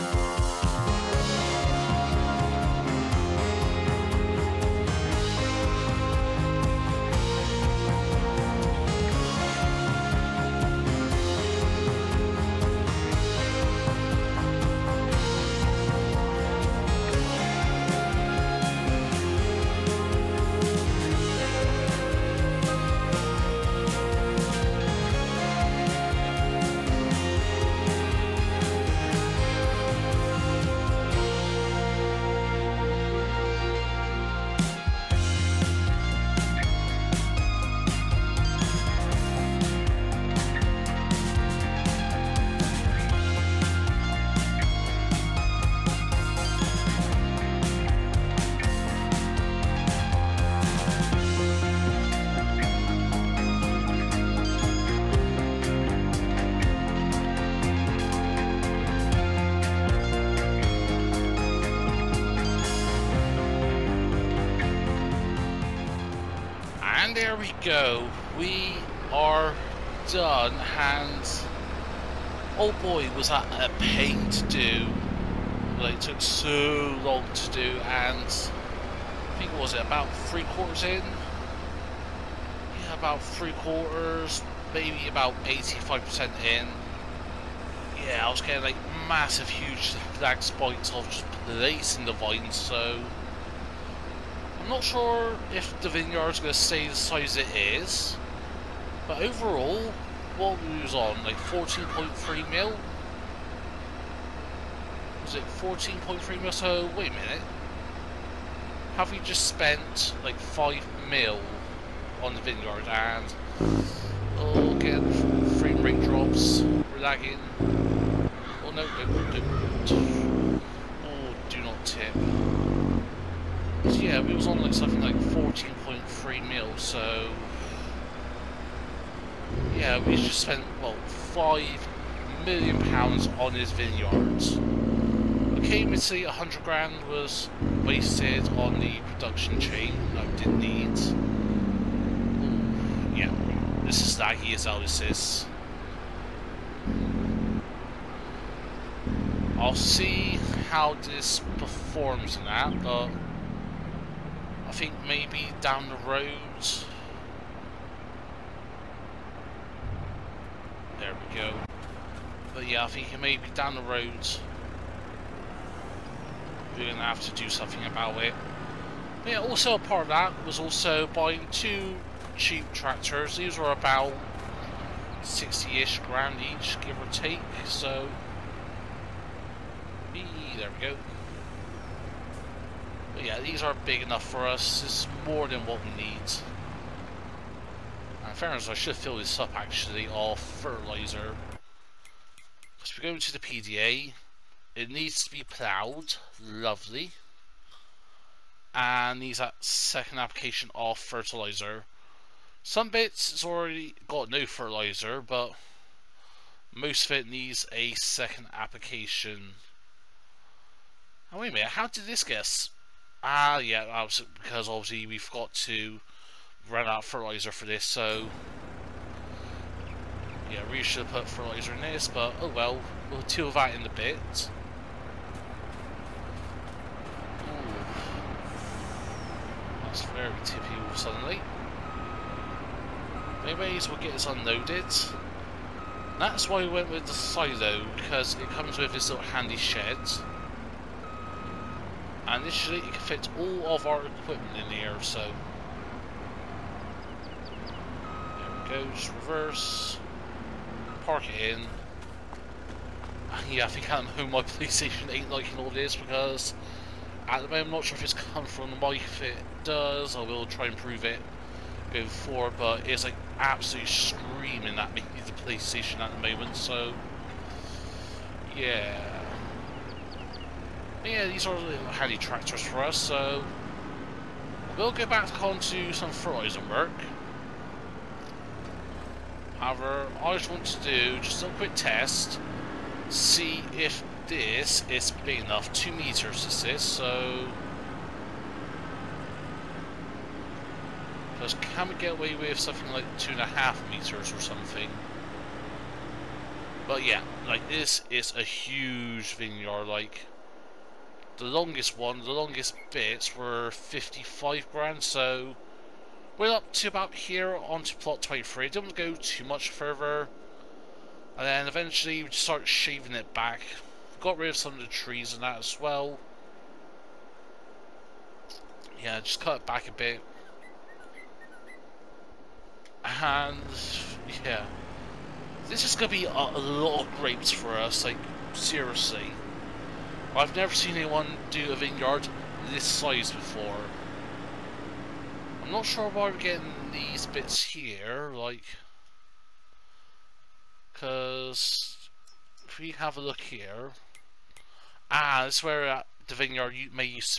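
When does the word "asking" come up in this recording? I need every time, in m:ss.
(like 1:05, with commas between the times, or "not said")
not said.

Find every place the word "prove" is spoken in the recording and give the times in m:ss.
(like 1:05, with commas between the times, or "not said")
4:20.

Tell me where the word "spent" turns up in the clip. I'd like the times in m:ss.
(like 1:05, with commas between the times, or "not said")
1:49, 2:10.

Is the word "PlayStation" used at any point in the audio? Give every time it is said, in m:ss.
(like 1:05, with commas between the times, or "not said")
4:14, 4:25.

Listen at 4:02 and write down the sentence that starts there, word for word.
And this should fit all of our equipment in here, so...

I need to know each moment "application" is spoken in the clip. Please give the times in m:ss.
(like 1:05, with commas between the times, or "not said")
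3:20, 3:28.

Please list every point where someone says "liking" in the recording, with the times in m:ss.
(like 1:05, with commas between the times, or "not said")
4:15.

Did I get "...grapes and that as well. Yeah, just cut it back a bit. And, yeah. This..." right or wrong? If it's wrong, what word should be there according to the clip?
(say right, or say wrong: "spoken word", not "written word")
wrong: "trees", not "grapes".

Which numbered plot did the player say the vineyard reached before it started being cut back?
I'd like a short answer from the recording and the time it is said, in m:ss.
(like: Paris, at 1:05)
plot 23, at 5:07.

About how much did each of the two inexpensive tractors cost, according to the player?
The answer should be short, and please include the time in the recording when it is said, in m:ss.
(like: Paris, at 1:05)
60 grand, at 2:55.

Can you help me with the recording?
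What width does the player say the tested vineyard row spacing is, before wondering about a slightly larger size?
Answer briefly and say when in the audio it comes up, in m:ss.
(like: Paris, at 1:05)
2 meters, at 4:45.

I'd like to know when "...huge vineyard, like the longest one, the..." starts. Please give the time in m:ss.
4:58.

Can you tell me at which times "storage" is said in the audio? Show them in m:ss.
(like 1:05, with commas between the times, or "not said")
not said.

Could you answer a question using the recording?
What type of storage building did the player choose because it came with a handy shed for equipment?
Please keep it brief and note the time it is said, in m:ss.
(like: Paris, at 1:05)
silo, at 3:57.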